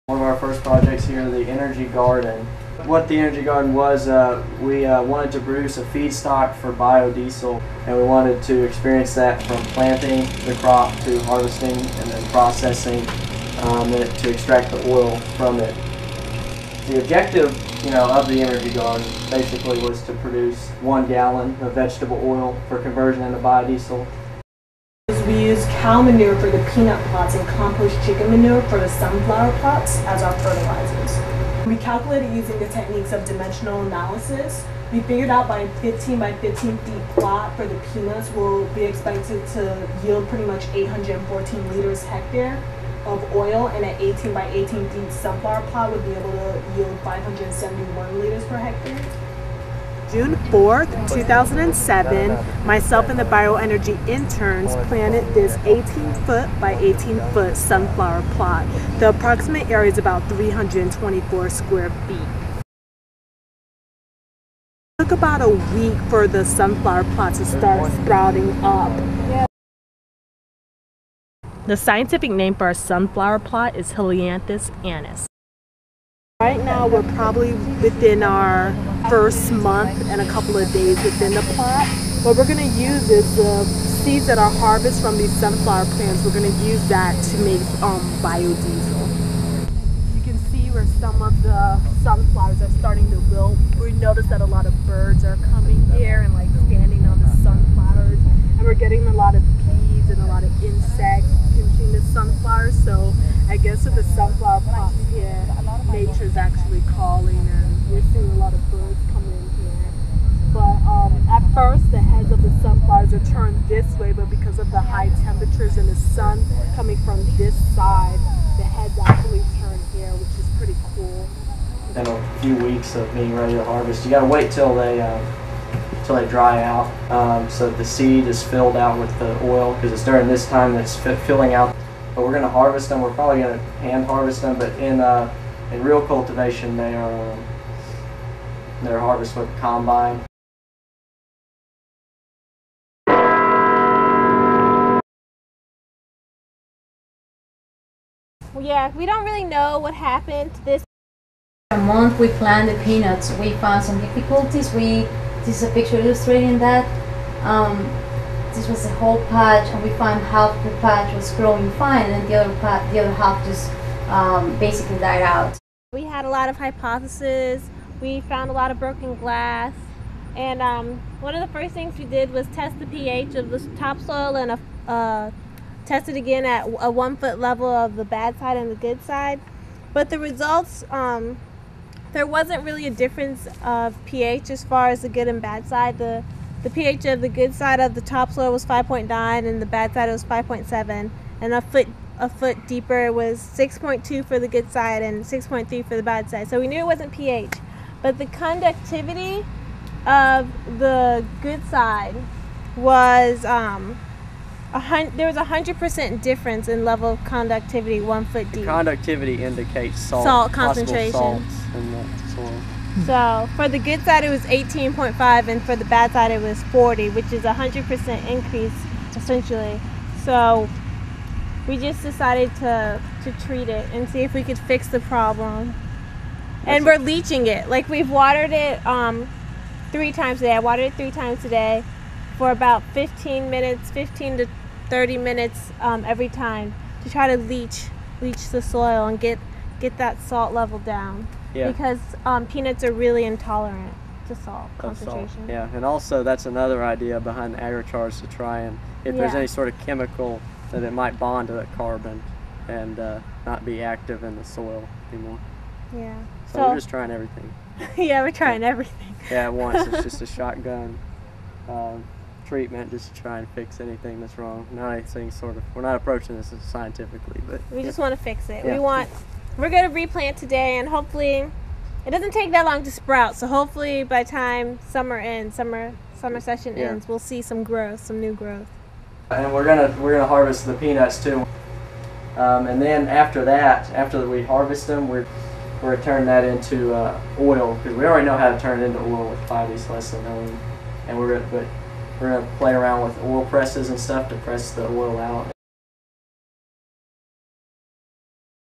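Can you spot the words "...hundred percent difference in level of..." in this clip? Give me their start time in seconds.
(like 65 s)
205 s.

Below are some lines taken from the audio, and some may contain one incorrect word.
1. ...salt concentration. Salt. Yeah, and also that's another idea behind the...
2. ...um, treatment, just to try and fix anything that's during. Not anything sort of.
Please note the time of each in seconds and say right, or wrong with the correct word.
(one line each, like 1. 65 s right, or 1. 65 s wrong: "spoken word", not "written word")
1. 244 s right
2. 261 s wrong: "wrong", not "during".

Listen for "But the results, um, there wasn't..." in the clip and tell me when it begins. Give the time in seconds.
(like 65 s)
179 s.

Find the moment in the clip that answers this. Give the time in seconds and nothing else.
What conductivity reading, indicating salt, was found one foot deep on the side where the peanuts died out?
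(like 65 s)
216 s.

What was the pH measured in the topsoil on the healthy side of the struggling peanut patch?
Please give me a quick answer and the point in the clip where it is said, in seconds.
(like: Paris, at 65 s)
5.9, at 188 s.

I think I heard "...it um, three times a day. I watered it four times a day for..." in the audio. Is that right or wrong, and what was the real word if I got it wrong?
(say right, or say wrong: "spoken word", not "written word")
wrong: "three", not "four".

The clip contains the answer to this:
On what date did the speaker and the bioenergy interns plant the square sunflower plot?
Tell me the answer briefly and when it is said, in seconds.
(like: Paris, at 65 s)
June 4th, 2007, at 50 s.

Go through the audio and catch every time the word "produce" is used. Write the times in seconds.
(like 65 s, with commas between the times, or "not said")
5 s, 20 s.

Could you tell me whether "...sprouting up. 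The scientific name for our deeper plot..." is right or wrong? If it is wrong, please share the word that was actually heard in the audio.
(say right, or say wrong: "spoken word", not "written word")
wrong: "sunflower", not "deeper".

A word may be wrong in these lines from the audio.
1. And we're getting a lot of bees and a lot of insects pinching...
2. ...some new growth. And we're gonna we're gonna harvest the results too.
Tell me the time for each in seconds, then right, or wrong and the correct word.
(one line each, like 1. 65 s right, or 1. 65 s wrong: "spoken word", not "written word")
1. 98 s right
2. 278 s wrong: "peanuts", not "results".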